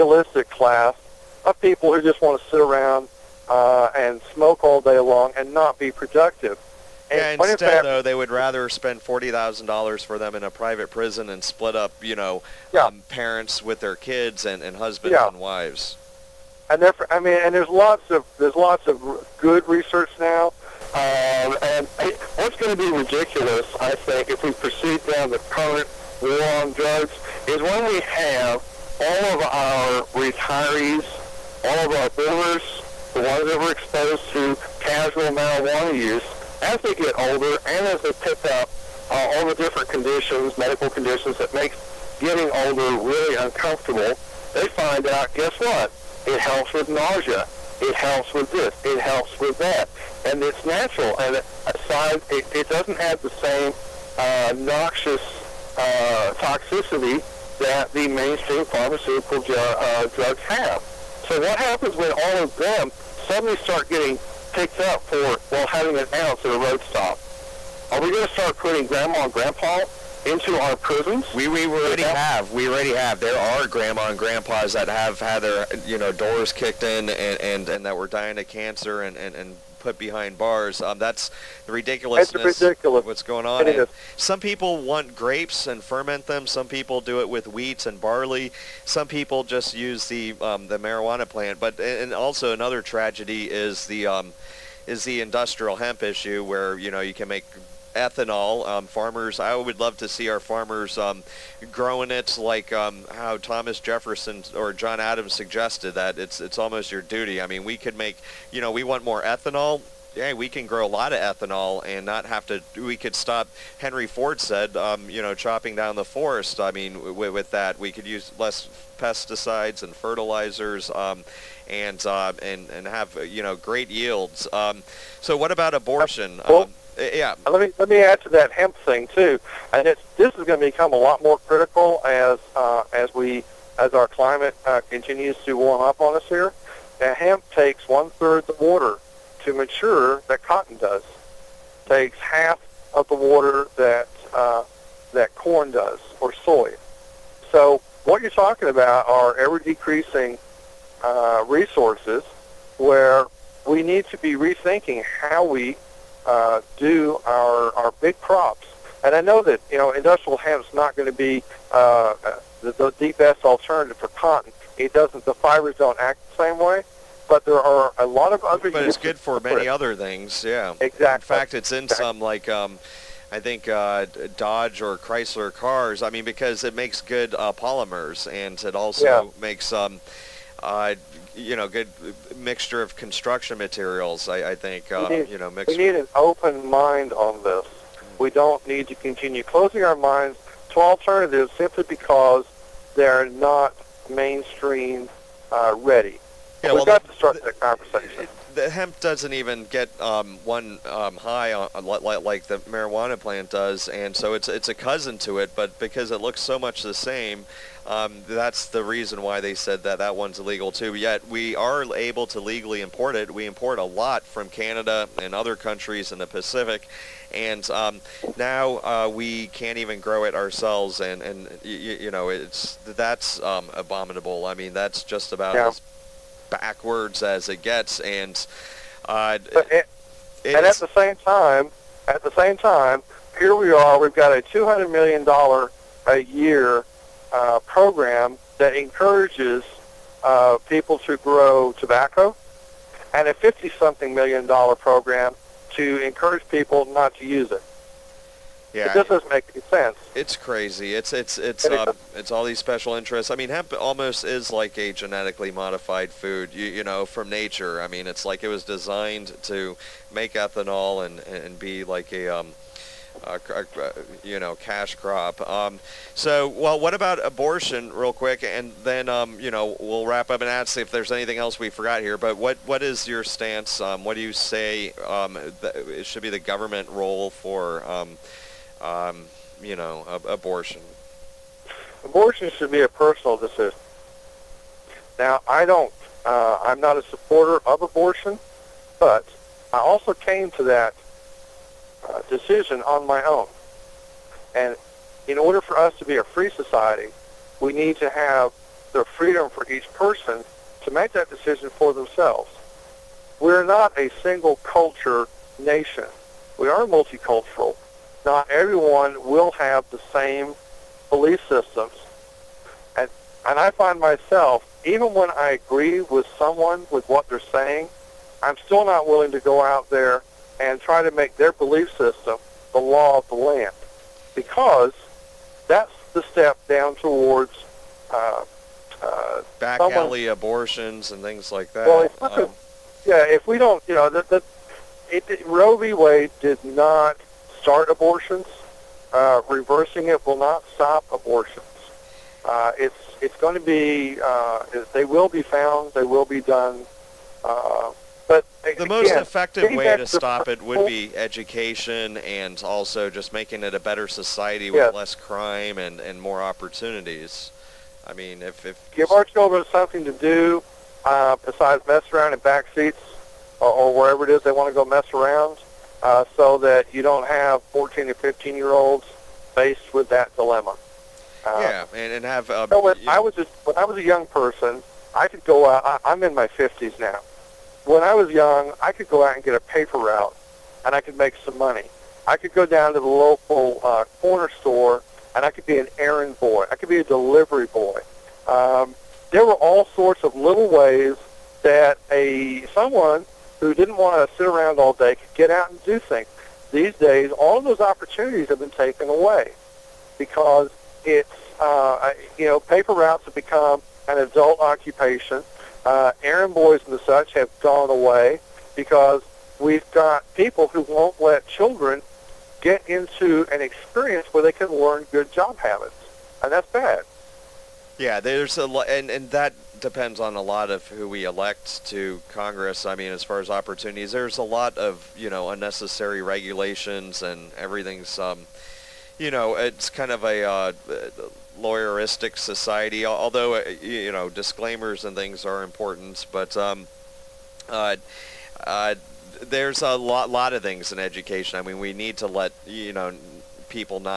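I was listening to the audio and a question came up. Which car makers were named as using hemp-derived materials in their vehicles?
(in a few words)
Dodge or Chrysler.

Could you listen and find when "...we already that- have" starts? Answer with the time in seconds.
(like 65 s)
71 s.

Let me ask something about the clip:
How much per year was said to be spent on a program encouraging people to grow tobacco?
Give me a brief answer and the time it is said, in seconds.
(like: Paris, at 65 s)
$200 million, at 234 s.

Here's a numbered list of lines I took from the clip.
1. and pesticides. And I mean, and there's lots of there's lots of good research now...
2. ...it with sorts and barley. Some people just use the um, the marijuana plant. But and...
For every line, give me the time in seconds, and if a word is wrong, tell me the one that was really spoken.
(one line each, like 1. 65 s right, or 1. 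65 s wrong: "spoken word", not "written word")
1. 15 s wrong: "wives", not "pesticides"
2. 87 s wrong: "wheats", not "sorts".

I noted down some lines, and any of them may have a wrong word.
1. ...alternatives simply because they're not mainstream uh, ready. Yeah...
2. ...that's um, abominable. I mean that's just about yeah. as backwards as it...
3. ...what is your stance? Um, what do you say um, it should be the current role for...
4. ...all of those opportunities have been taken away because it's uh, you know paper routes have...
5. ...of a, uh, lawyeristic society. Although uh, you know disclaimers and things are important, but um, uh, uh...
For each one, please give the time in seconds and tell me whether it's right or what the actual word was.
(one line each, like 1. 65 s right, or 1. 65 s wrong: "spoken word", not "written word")
1. 190 s right
2. 222 s right
3. 272 s wrong: "government", not "current"
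4. 397 s right
5. 430 s right.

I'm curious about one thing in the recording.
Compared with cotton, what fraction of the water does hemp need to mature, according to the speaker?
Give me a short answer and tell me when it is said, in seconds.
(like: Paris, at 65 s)
One third, at 137 s.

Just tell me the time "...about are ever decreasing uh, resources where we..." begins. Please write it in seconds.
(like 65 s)
148 s.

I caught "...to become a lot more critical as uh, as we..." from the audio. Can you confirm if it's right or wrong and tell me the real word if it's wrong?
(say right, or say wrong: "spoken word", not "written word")
right.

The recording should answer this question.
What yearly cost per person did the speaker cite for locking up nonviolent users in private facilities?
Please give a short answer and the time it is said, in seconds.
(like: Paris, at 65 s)
$40,000, at 8 s.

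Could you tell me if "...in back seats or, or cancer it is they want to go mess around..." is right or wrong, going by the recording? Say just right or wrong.
wrong.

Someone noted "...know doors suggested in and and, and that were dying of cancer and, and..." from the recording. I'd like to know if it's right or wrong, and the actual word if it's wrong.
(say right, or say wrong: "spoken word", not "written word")
wrong: "kicked", not "suggested".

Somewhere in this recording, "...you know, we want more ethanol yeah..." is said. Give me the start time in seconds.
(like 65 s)
108 s.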